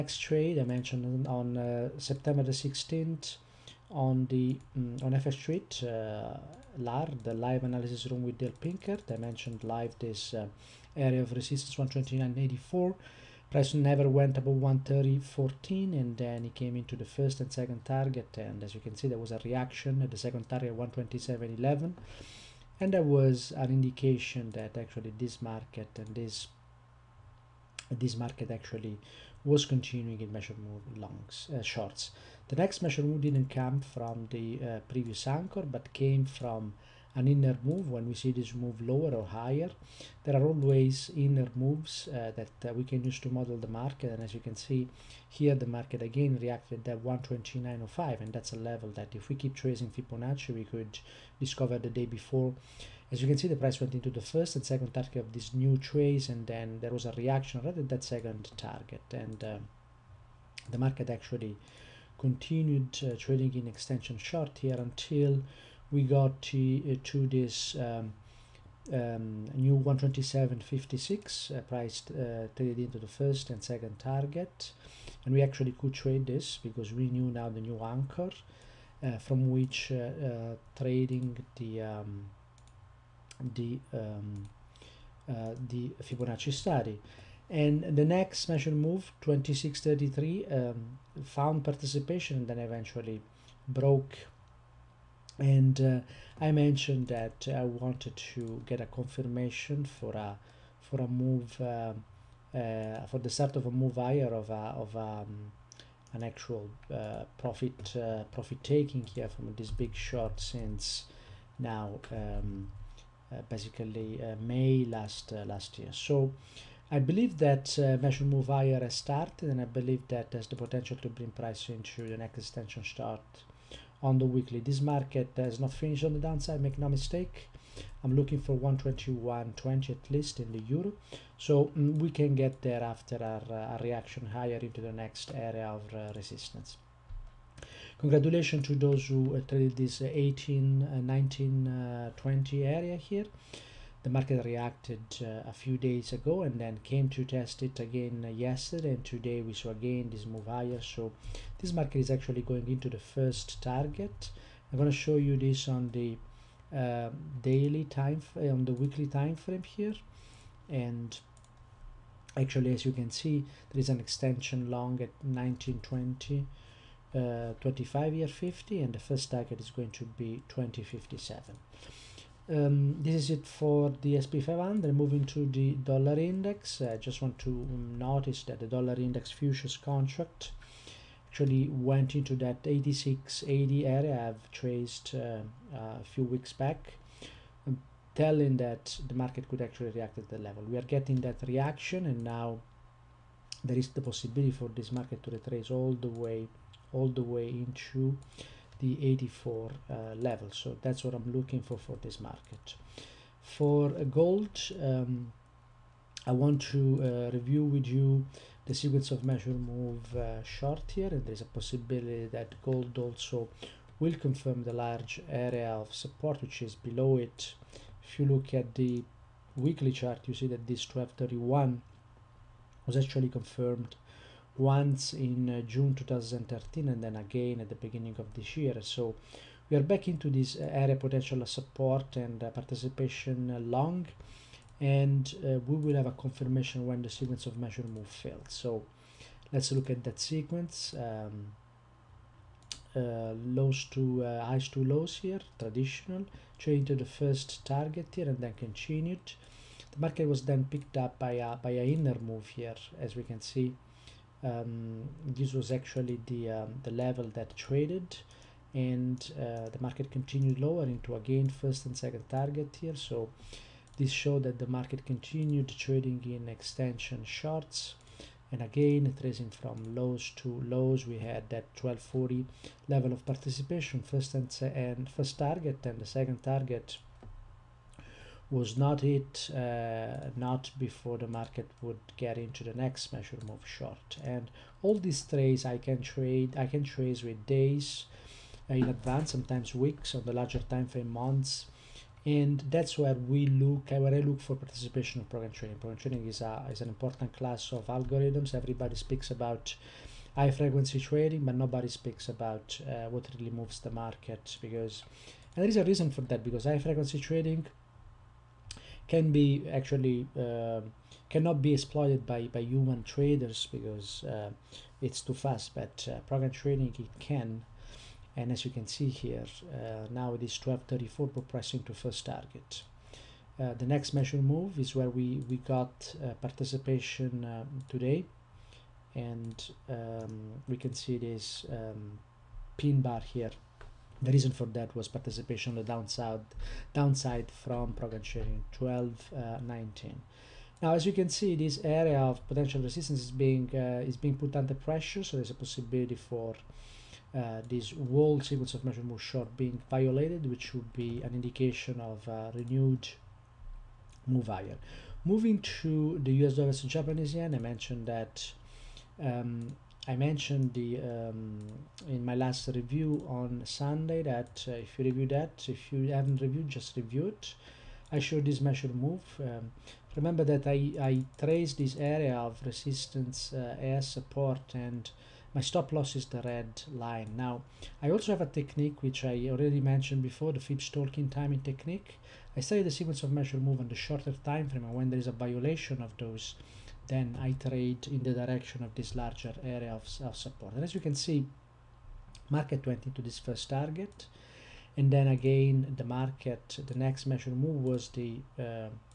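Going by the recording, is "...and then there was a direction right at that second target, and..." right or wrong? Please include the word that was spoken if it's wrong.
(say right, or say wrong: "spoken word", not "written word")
wrong: "reaction", not "direction".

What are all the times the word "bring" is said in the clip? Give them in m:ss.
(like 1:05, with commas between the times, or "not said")
2:01.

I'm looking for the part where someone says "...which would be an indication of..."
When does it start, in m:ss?
5:50.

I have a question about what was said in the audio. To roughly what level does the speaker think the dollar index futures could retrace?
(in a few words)
84.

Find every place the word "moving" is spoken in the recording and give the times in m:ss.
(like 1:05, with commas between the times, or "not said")
2:54, 5:55.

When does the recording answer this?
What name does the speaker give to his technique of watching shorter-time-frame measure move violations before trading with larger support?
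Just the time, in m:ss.
6:20.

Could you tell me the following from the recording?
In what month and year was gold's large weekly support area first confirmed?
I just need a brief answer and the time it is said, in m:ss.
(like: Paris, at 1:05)
June 2013, at 3:45.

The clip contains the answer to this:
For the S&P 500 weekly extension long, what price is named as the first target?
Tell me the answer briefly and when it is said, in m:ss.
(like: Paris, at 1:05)
2057, at 2:50.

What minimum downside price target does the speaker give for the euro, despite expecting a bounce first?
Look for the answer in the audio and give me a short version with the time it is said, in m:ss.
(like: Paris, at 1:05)
121.20, at 2:08.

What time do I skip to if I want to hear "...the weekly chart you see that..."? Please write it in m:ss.
3:38.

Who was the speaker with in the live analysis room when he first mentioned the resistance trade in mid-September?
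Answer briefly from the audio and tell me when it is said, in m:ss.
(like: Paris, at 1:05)
Dale Pinkert, at 0:08.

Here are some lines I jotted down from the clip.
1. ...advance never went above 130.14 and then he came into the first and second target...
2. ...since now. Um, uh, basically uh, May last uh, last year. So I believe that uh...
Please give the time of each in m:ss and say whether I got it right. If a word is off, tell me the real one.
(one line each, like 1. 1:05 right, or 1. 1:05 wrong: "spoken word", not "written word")
1. 0:13 wrong: "price", not "advance"
2. 1:50 right.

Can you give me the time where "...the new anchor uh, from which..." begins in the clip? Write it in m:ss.
1:17.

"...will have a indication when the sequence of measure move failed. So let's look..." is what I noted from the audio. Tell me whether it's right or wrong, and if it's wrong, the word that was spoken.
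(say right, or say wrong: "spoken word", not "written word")
wrong: "confirmation", not "indication".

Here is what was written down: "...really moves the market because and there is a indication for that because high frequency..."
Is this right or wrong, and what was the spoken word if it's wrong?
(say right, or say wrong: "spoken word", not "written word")
wrong: "reason", not "indication".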